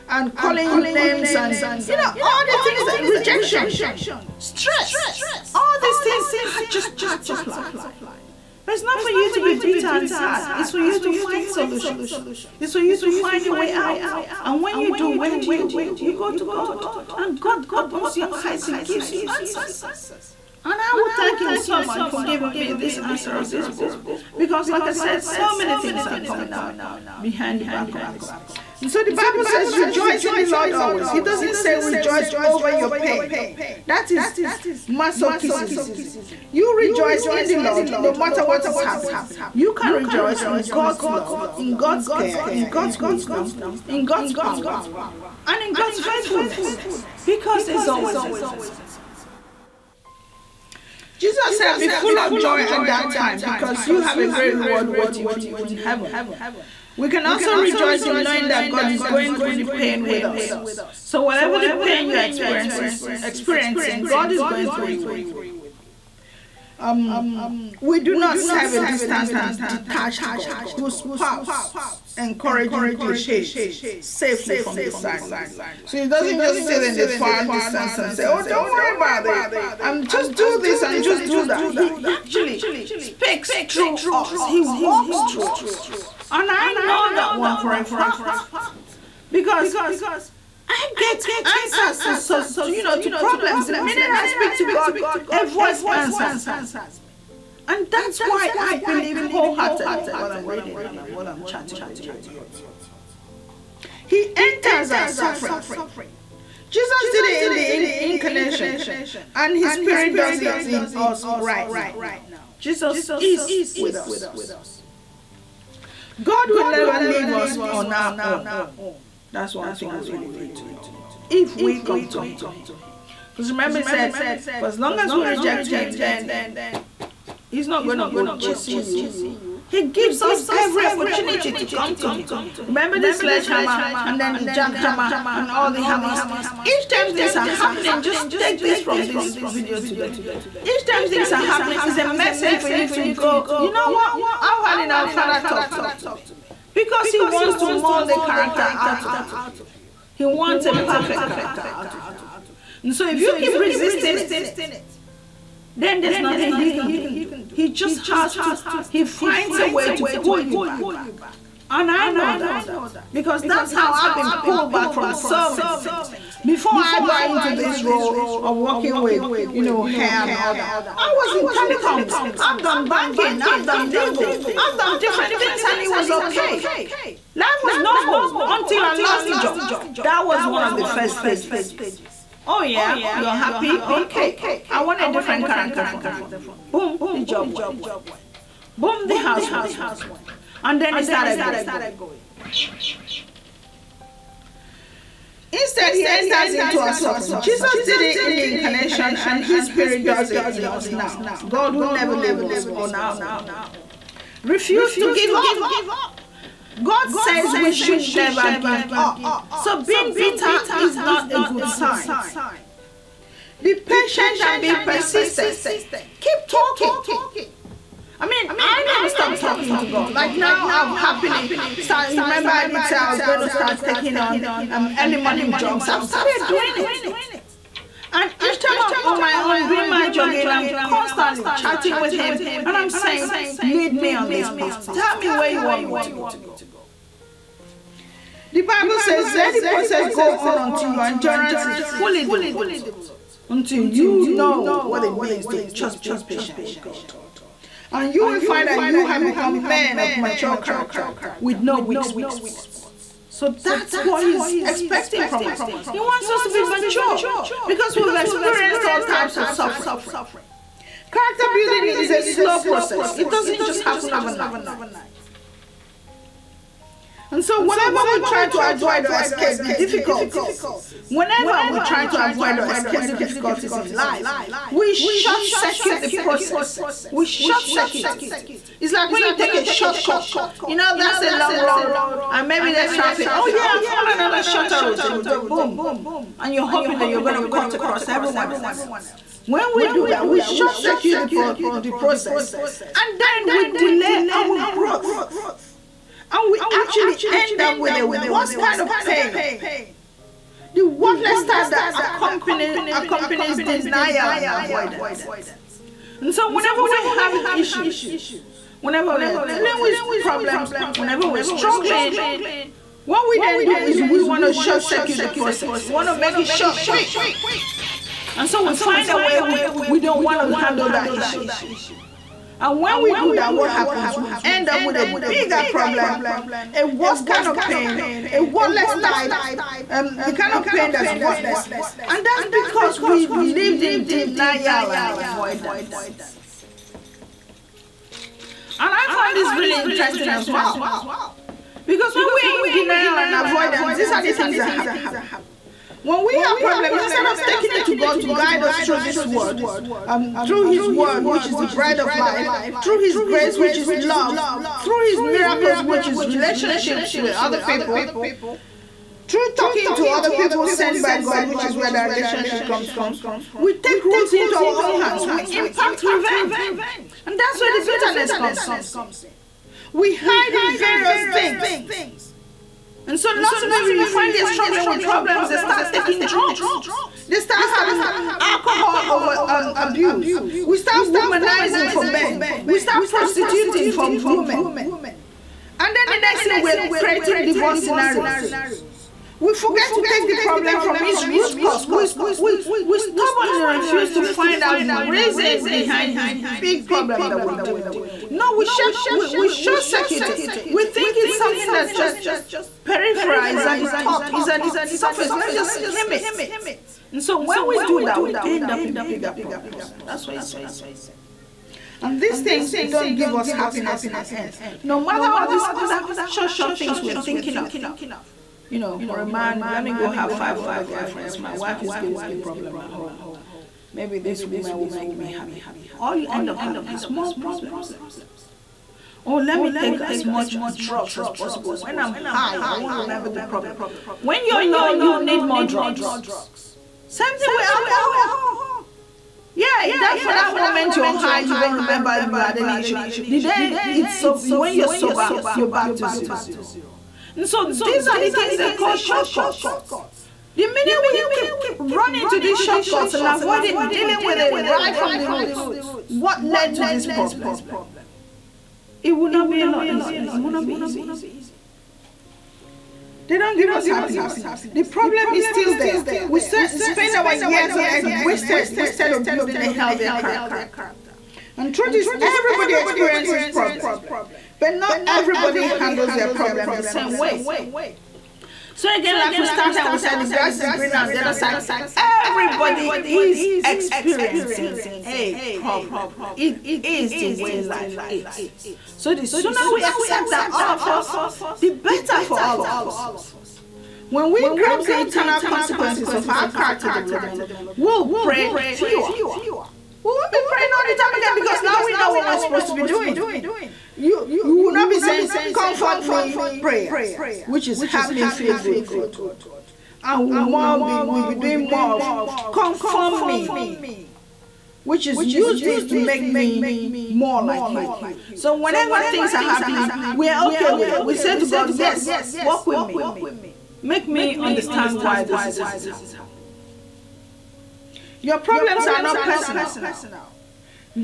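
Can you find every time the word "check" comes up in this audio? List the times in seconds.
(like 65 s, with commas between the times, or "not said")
not said.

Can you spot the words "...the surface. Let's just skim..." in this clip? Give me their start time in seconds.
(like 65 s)
404 s.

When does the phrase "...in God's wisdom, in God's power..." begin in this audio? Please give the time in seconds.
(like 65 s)
42 s.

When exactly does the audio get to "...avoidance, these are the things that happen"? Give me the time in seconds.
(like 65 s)
343 s.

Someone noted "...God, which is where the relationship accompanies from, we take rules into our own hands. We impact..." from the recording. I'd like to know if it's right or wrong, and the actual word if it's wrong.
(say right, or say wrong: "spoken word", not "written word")
wrong: "comes", not "accompanies".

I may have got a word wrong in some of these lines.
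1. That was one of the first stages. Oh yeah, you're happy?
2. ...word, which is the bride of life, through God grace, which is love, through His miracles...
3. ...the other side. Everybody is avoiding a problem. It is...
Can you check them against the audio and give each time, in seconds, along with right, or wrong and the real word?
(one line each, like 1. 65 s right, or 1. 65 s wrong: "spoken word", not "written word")
1. 180 s right
2. 350 s wrong: "His", not "God"
3. 481 s wrong: "experiencing", not "avoiding".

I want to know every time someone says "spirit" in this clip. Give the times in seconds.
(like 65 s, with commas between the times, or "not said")
109 s, 199 s.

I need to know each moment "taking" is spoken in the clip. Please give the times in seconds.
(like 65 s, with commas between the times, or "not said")
223 s, 347 s, 375 s.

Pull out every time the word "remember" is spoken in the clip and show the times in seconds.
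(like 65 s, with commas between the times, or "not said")
123 s, 132 s, 222 s, 432 s, 441 s.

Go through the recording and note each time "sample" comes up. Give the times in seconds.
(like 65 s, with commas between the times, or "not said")
not said.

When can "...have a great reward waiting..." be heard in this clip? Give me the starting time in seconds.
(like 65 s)
54 s.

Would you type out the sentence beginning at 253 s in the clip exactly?
So that's what he's expecting from us.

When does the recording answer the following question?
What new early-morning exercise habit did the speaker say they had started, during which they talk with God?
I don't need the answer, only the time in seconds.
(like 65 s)
224 s.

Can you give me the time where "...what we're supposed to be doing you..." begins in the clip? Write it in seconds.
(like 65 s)
502 s.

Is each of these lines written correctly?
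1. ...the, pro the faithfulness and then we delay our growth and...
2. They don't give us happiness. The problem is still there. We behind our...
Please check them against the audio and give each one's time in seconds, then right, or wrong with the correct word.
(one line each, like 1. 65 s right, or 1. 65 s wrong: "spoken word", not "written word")
1. 291 s wrong: "process", not "faithfulness"
2. 463 s wrong: "spend", not "behind".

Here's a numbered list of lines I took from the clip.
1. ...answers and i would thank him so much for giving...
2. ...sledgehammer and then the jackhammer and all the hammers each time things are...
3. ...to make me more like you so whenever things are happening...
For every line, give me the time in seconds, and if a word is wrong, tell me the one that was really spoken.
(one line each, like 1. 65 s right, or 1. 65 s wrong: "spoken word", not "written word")
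1. 19 s right
2. 133 s right
3. 515 s right.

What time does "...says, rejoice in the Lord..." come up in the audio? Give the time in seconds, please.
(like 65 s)
29 s.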